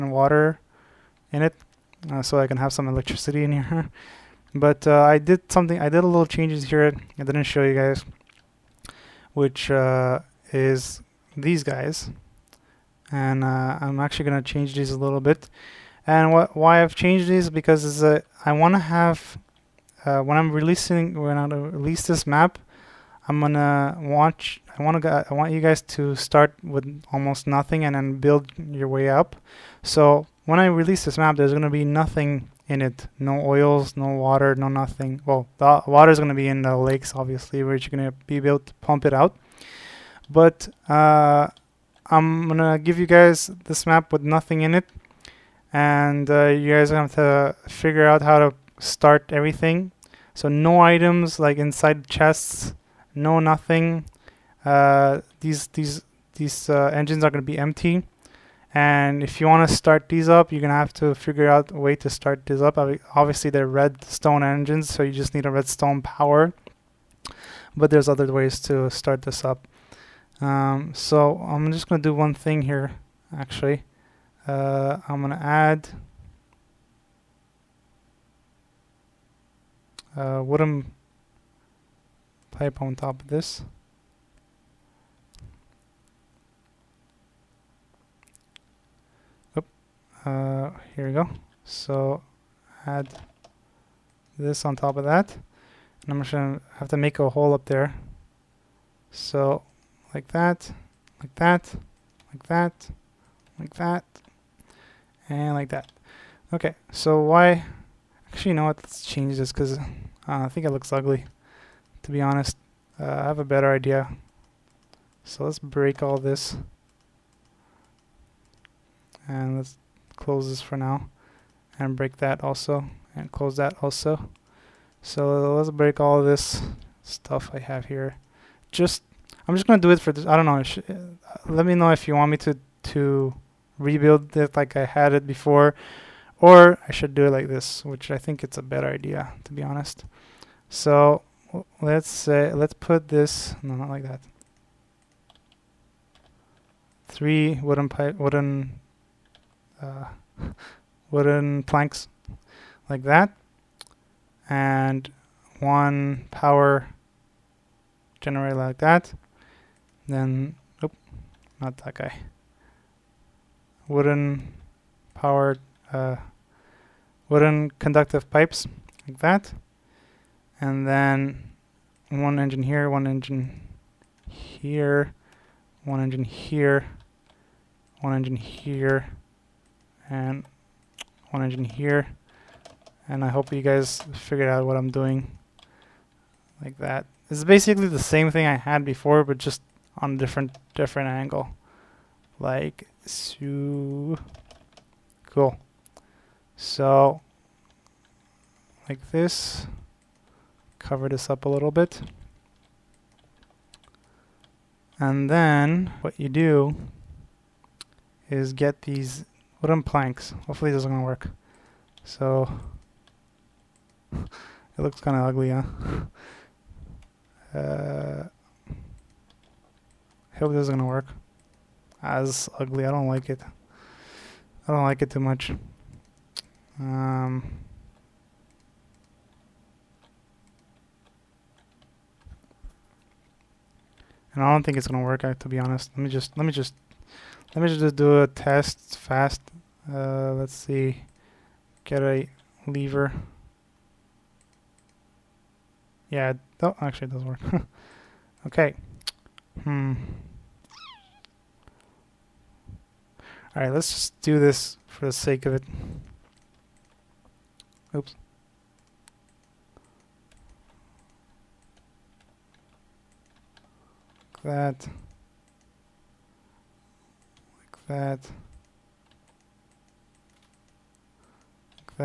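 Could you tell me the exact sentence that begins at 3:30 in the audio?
Hopefully this is going to work.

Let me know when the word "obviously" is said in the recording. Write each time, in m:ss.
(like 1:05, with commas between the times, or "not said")
0:37, 1:03.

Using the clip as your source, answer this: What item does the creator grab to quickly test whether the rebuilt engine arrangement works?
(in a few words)
a lever.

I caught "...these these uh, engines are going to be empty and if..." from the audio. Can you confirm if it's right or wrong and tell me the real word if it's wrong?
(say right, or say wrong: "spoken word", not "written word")
right.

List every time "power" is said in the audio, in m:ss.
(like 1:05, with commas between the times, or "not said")
1:06, 2:36, 2:45.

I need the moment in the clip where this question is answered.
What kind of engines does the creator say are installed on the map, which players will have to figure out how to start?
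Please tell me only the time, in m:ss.
1:03.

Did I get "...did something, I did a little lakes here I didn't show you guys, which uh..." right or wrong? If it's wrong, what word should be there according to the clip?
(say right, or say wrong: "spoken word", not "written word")
wrong: "changes", not "lakes".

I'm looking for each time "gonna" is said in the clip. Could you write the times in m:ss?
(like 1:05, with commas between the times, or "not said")
0:23, 1:36, 2:09, 3:54.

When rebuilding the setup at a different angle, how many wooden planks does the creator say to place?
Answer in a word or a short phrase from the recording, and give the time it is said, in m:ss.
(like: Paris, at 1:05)
3, at 2:27.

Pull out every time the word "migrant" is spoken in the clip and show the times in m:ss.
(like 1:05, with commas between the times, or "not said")
not said.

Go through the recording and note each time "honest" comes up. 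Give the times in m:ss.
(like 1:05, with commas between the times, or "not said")
1:52, 2:19, 3:55.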